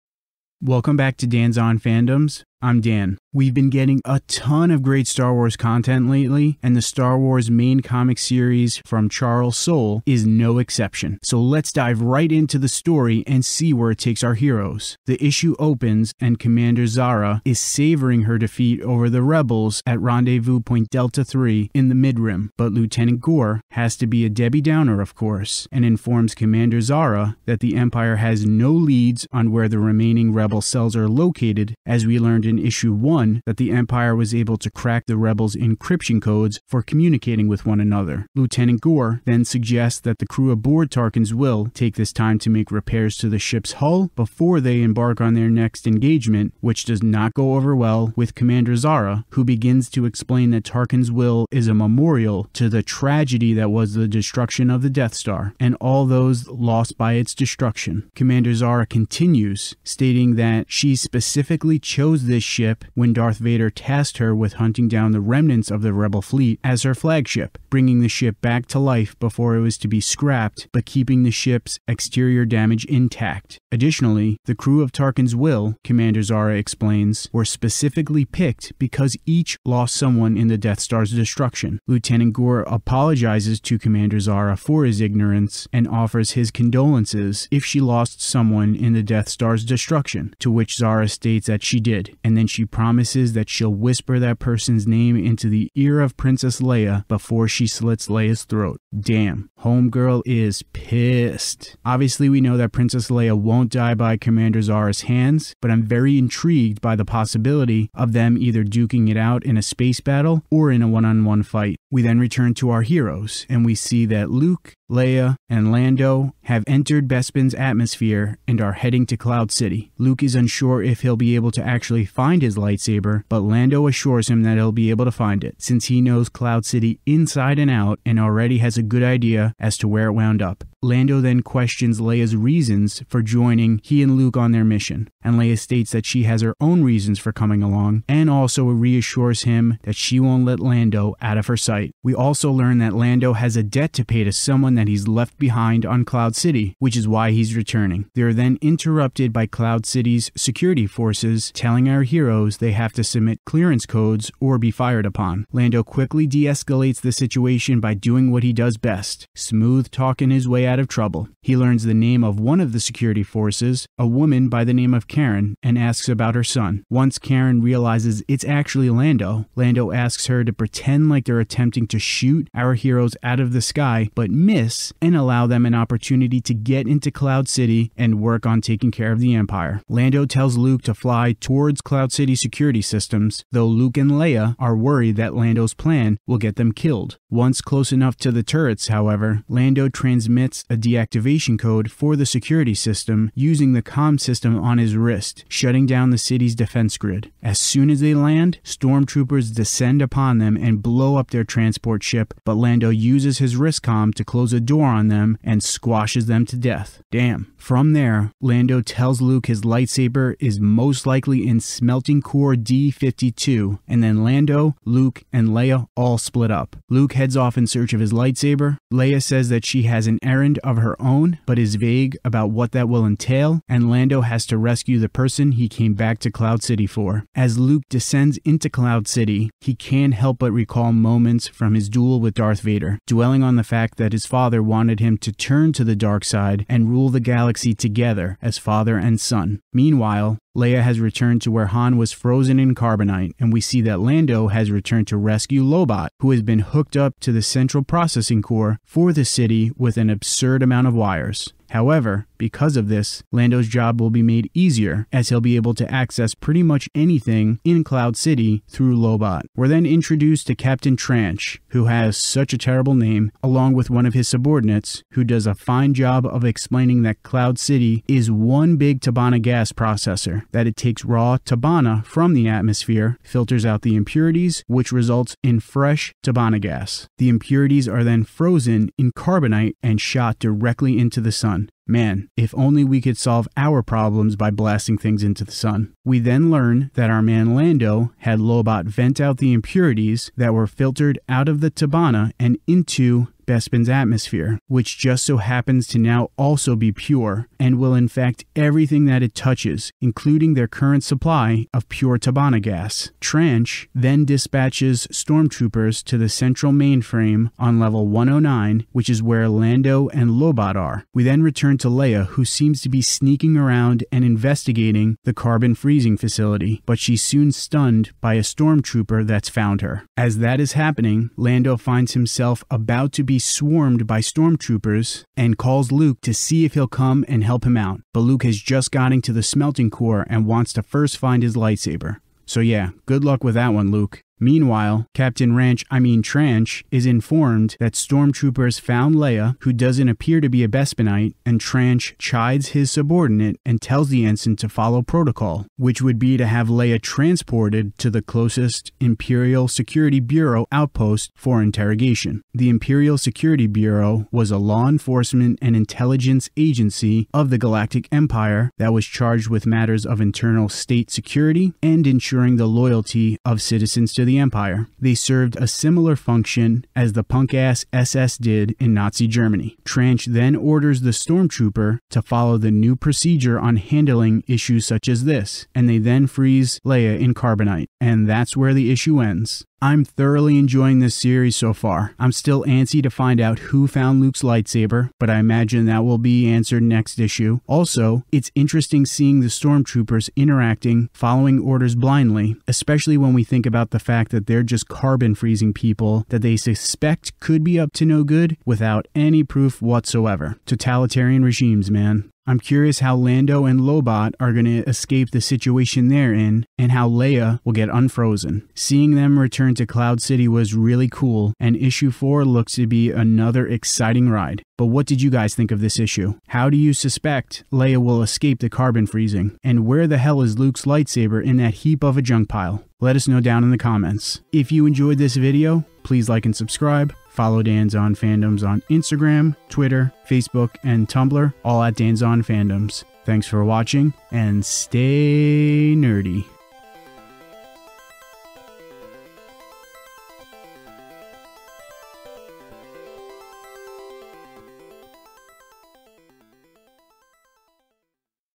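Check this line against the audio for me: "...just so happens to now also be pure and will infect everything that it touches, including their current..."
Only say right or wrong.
right.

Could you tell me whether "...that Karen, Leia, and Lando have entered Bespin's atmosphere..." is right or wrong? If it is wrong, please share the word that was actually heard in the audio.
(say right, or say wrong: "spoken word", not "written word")
wrong: "Luke", not "Karen".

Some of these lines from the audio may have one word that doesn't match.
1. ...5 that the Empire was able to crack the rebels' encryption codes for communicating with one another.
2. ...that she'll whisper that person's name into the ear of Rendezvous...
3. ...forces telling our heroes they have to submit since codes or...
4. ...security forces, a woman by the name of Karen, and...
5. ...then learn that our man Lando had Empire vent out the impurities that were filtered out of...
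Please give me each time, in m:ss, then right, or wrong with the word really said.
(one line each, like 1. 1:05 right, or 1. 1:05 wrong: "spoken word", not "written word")
1. 0:32 wrong: "1", not "5"
2. 1:33 wrong: "Princess", not "Rendezvous"
3. 2:30 wrong: "clearance", not "since"
4. 2:42 right
5. 4:46 wrong: "Lobot", not "Empire".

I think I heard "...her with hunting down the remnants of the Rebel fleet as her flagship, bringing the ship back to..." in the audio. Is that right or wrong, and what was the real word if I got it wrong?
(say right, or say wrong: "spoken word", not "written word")
right.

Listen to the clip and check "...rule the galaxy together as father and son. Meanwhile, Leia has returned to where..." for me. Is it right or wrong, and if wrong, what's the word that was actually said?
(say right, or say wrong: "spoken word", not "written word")
right.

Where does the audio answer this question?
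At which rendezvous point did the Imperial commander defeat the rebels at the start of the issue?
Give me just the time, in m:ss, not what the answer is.
0:19.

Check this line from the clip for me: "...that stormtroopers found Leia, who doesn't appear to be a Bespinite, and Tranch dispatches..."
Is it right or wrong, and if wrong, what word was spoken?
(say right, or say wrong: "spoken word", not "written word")
wrong: "chides", not "dispatches".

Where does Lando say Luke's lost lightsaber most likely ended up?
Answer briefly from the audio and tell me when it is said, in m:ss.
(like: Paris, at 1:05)
Smelting Core D52, at 3:31.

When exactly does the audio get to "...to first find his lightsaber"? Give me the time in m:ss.
5:30.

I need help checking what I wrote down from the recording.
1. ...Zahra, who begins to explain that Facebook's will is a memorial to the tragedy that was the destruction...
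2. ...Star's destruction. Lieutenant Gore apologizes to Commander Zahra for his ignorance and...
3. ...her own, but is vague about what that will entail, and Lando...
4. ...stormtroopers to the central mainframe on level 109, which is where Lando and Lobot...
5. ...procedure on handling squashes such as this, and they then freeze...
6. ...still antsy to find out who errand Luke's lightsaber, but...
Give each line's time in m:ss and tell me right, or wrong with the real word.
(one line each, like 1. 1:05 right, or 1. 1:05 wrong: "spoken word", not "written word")
1. 0:48 wrong: "Tarkin", not "Facebook"
2. 1:20 right
3. 3:40 right
4. 5:05 right
5. 6:12 wrong: "issues", not "squashes"
6. 6:22 wrong: "found", not "errand".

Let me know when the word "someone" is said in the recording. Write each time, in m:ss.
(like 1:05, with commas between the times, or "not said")
1:19, 1:28, 2:24.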